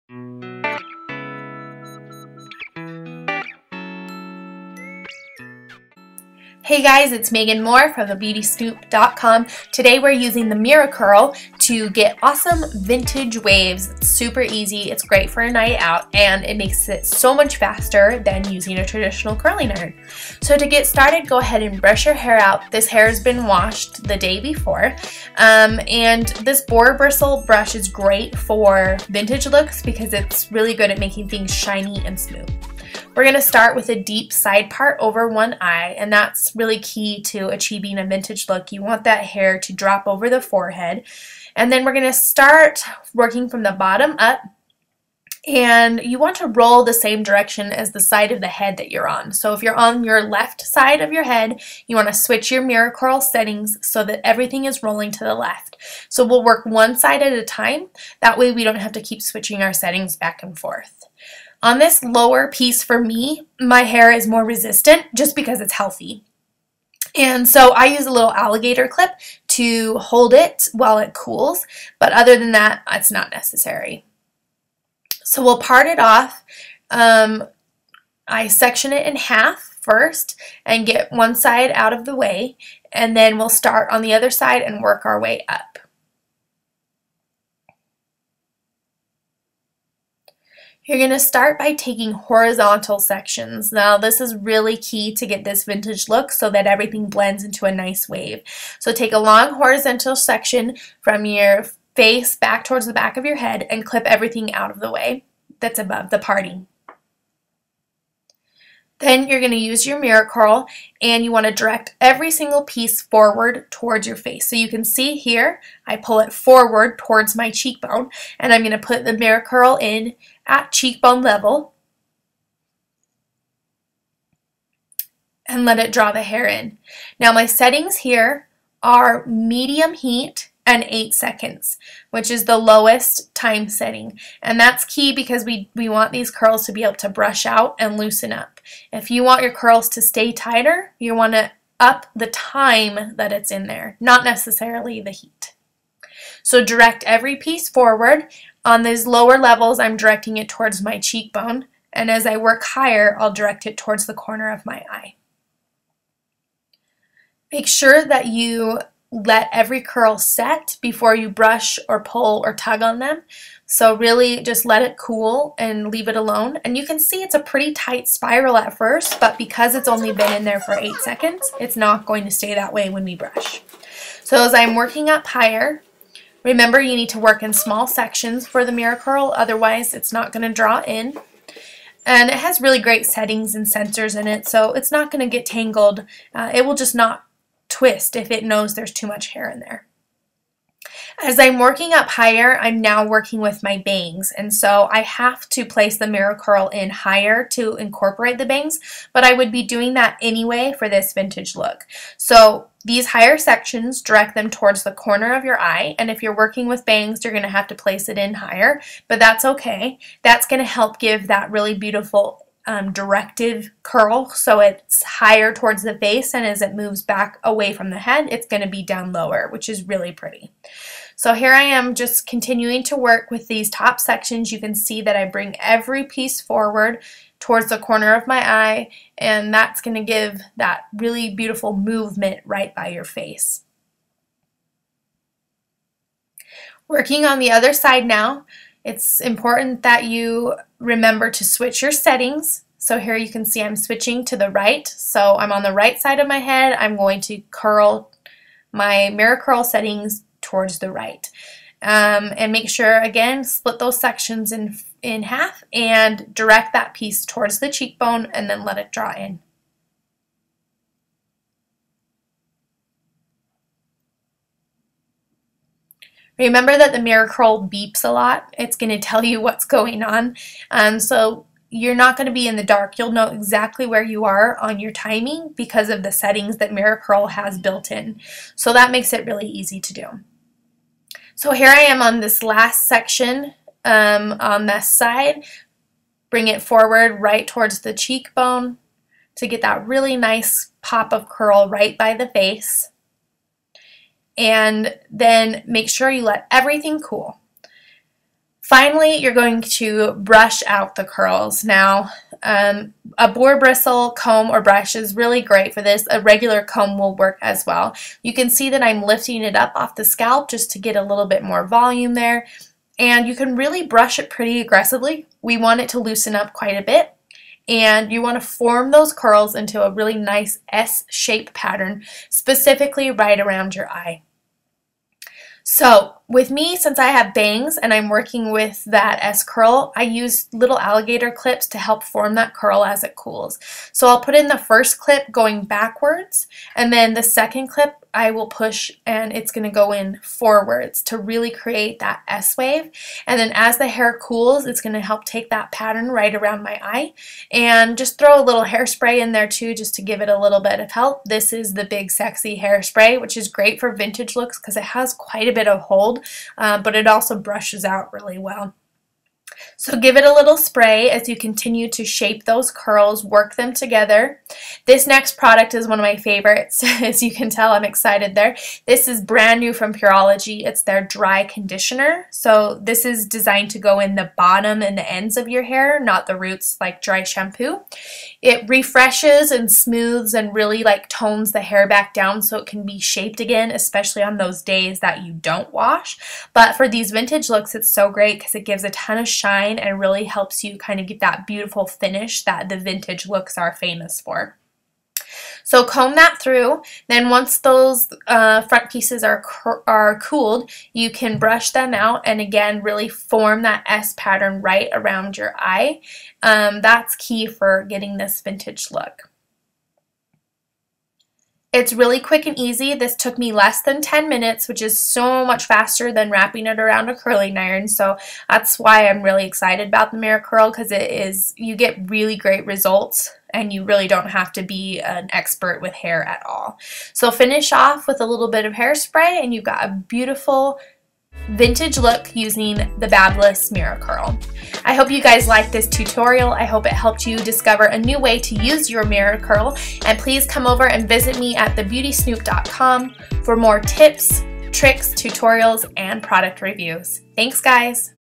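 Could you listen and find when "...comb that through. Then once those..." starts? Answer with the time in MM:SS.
06:35.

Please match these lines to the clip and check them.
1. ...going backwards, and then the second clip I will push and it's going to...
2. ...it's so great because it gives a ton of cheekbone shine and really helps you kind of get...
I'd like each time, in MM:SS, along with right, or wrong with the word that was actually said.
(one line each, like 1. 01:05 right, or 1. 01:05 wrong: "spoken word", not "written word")
1. 05:35 right
2. 06:27 wrong: "shine", not "cheekbone".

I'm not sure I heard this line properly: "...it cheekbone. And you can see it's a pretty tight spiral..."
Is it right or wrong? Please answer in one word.
wrong.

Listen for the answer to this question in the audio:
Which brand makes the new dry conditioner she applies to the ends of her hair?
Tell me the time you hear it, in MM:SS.
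06:09.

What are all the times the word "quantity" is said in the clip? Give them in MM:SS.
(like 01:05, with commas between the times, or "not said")
not said.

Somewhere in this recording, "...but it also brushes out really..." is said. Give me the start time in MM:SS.
05:56.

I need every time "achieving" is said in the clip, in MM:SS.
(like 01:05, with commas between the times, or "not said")
00:37.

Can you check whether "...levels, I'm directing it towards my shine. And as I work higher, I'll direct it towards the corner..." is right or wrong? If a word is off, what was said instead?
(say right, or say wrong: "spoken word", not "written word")
wrong: "cheekbone", not "shine".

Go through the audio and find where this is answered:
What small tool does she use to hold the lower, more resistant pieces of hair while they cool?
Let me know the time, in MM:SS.
01:08.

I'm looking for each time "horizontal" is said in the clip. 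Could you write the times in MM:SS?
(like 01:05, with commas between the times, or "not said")
01:32, 01:39.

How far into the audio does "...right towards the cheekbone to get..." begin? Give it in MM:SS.
04:47.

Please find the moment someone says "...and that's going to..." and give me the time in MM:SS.
03:49.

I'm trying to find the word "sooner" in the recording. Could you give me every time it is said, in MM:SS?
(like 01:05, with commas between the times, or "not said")
not said.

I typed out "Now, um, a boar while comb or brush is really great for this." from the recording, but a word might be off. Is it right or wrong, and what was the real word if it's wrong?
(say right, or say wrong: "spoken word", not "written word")
wrong: "bristle", not "while".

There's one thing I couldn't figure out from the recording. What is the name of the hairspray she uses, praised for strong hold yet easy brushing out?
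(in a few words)
Big Sexy Hairspray.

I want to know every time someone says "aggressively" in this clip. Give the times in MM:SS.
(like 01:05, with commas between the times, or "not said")
05:14.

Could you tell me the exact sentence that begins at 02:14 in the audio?
And that's key because we, we want these curls to be able to brush out and loosen up.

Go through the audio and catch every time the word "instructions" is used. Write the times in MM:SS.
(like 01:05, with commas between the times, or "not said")
not said.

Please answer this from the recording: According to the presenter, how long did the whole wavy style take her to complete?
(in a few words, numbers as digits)
less than 10 minutes.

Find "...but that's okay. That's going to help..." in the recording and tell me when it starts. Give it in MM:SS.
03:29.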